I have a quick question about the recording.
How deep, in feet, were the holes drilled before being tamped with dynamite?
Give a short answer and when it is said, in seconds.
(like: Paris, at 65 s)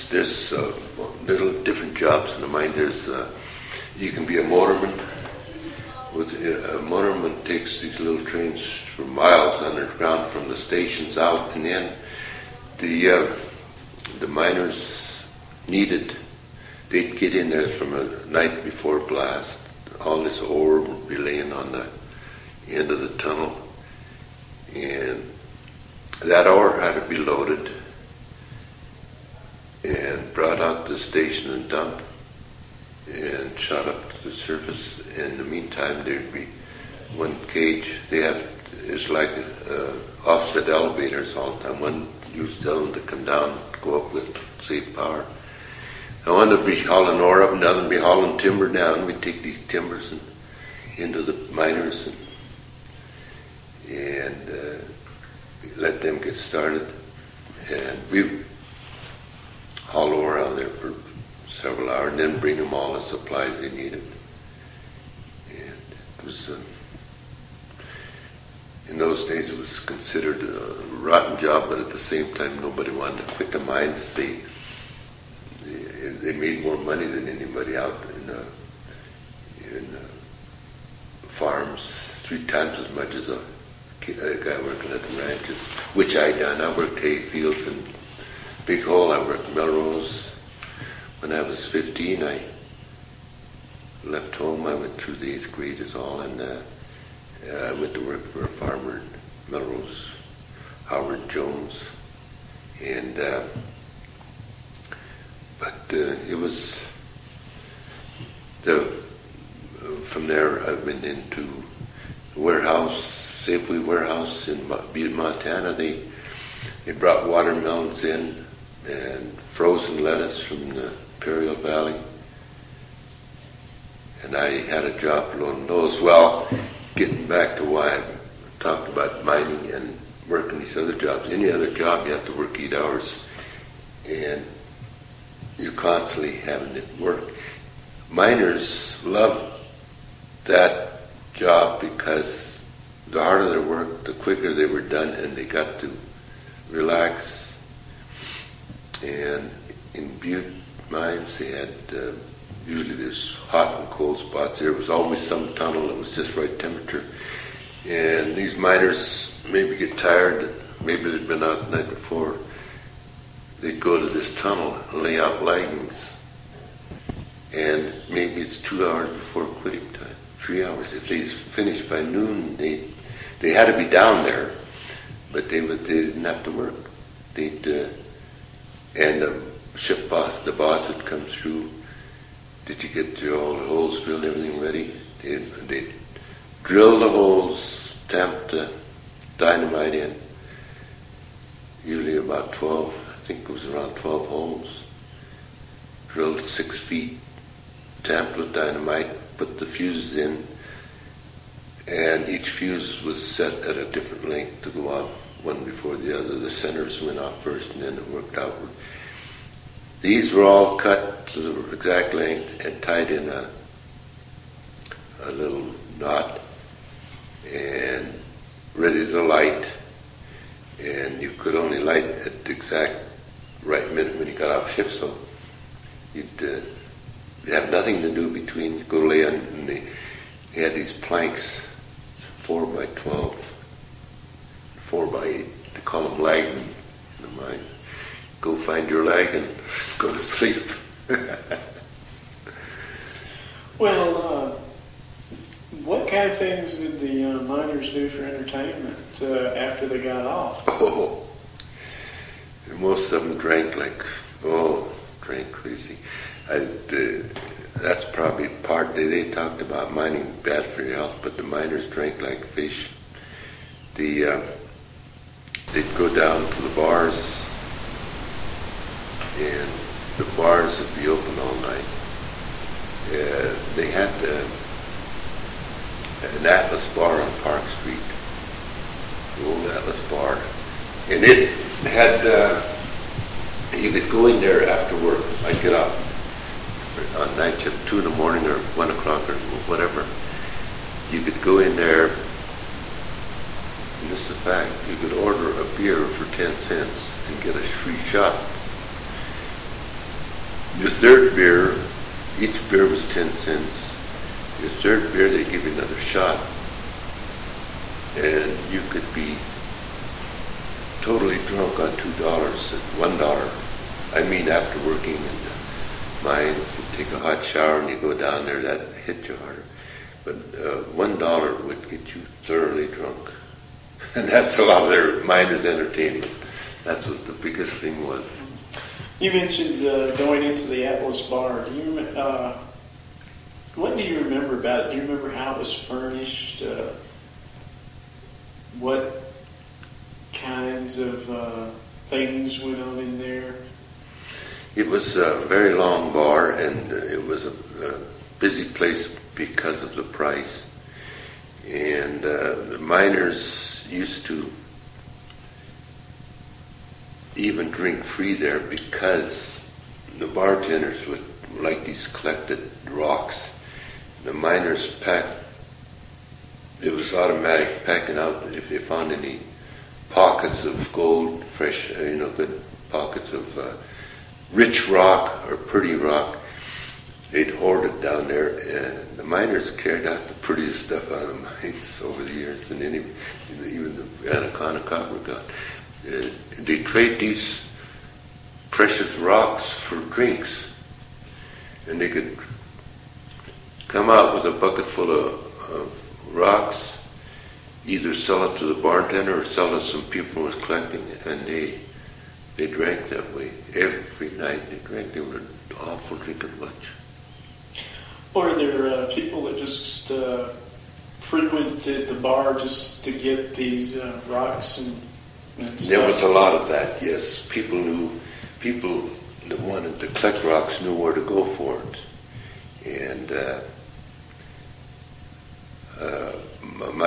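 6 feet, at 196 s.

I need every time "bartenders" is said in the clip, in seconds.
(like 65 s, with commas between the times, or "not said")
360 s, 398 s.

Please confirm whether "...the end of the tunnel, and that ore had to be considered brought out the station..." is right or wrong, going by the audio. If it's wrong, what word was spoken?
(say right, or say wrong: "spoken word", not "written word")
wrong: "loaded", not "considered".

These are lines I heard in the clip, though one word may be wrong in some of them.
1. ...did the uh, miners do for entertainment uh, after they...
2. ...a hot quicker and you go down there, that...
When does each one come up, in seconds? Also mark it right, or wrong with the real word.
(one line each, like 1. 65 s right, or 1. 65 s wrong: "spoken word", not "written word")
1. 246 s right
2. 317 s wrong: "shower", not "quicker".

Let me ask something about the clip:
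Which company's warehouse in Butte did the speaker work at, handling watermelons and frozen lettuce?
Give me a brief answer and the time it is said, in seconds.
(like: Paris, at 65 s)
Safeway, at 113 s.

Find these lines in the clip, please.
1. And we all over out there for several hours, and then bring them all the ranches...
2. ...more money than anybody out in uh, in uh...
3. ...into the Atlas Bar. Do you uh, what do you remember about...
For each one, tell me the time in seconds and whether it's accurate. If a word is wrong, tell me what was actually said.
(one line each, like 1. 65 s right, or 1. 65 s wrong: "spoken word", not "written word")
1. 57 s wrong: "supplies", not "ranches"
2. 76 s right
3. 330 s right.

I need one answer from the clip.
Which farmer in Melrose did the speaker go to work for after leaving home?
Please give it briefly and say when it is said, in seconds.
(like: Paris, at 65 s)
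Howard Jones, at 100 s.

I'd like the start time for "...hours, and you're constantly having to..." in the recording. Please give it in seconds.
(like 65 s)
132 s.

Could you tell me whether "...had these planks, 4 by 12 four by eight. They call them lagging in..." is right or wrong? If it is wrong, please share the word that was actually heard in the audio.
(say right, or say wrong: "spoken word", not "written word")
right.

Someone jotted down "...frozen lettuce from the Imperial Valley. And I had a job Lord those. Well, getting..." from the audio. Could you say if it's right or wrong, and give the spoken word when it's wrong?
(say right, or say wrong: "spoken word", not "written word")
right.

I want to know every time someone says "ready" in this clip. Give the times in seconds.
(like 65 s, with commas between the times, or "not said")
184 s, 218 s.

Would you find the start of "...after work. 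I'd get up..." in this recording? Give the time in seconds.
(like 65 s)
284 s.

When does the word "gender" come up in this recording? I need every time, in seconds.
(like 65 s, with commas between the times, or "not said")
not said.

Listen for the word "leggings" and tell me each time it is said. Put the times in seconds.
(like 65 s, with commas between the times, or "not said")
165 s.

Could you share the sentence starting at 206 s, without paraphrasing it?
The centers went off first and then it worked outward.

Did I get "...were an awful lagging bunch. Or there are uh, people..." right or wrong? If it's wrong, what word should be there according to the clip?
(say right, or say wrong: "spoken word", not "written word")
wrong: "drinking", not "lagging".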